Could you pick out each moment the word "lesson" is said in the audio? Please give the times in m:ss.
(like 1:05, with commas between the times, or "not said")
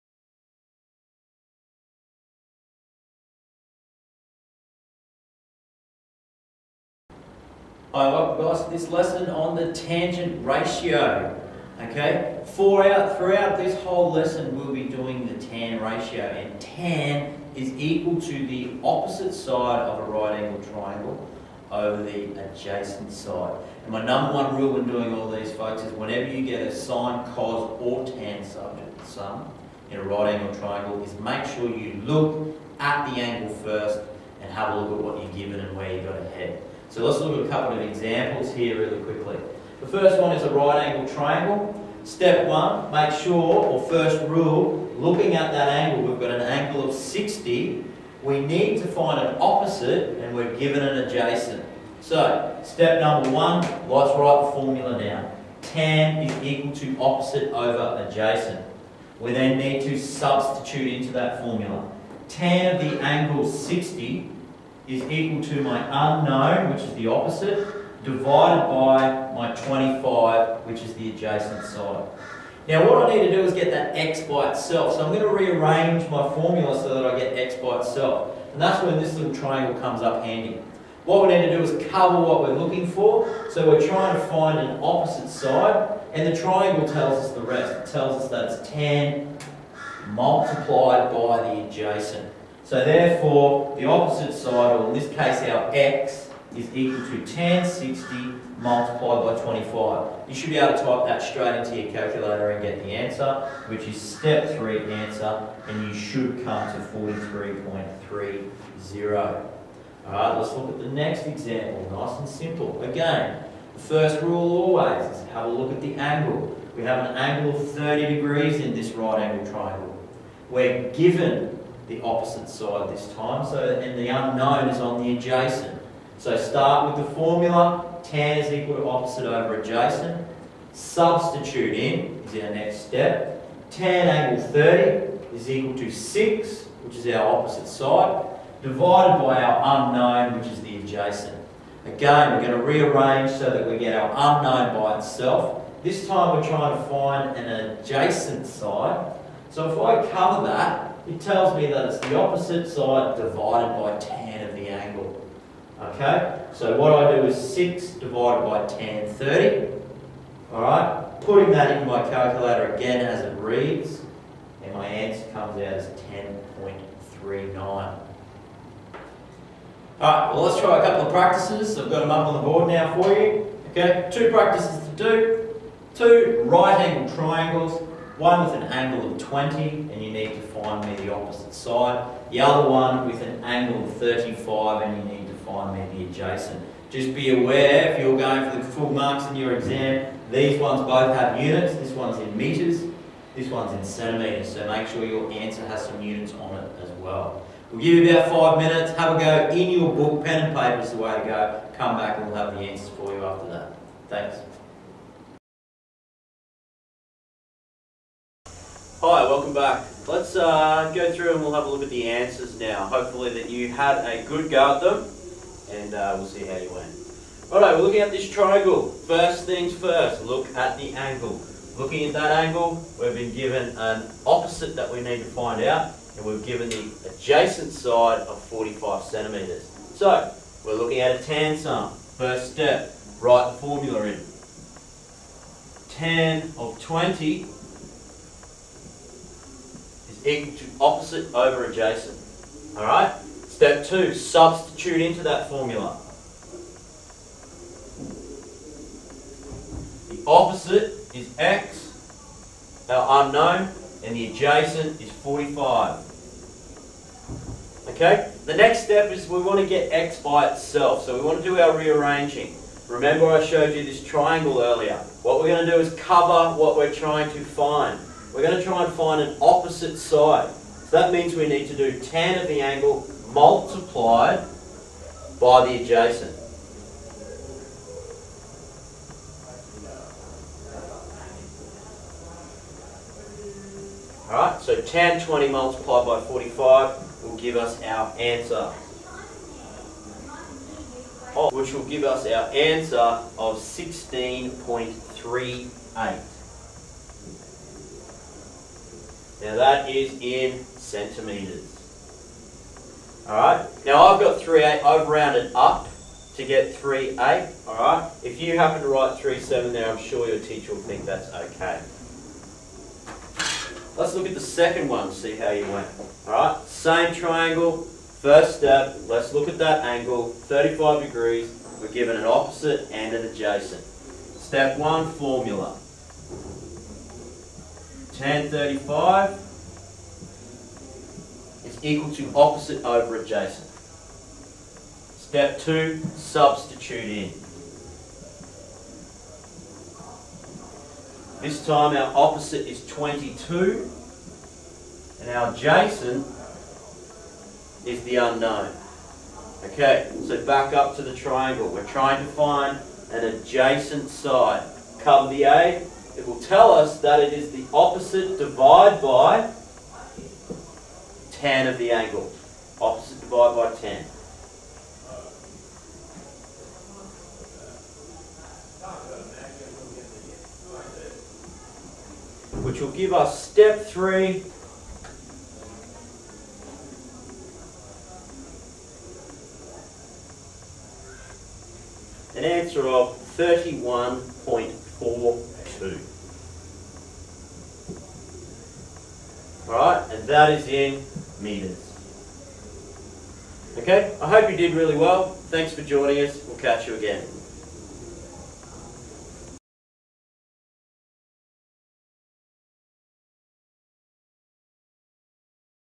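0:08, 0:14.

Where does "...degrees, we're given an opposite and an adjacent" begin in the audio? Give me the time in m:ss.
5:21.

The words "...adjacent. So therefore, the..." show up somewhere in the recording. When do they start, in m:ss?
1:31.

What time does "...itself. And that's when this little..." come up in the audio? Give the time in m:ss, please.
1:17.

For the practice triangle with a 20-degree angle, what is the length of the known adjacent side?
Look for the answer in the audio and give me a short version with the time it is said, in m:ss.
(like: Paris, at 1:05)
45 centimetres, at 3:48.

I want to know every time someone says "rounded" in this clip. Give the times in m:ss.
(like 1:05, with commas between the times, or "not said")
5:05.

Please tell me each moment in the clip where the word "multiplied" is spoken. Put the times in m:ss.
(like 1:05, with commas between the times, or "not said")
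1:30, 1:38, 4:33, 4:45.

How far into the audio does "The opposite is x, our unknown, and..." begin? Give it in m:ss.
4:10.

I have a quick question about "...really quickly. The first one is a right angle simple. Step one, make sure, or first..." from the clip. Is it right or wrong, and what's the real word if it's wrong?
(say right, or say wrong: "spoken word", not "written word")
wrong: "triangle", not "simple".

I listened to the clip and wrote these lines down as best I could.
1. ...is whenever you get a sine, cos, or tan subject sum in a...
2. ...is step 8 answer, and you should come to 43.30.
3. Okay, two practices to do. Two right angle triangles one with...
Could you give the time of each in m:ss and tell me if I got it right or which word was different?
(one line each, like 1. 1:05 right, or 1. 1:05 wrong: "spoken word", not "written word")
1. 0:25 right
2. 1:43 wrong: "3", not "8"
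3. 2:53 right.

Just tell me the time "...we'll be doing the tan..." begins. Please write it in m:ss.
0:14.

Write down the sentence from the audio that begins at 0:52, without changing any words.
So, step number one, let's write the formula down.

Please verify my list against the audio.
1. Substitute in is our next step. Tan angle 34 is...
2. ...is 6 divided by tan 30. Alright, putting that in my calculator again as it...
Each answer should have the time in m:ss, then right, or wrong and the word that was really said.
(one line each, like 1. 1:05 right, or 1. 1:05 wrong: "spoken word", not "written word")
1. 2:10 wrong: "30", not "34"
2. 2:37 right.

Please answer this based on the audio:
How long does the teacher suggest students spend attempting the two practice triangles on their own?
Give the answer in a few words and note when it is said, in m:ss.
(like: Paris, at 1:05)
About five minutes, at 3:18.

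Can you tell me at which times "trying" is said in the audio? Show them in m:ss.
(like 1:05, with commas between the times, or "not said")
1:23, 2:26, 4:26, 5:51.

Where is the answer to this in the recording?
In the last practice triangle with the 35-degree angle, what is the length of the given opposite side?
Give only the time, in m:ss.
5:42.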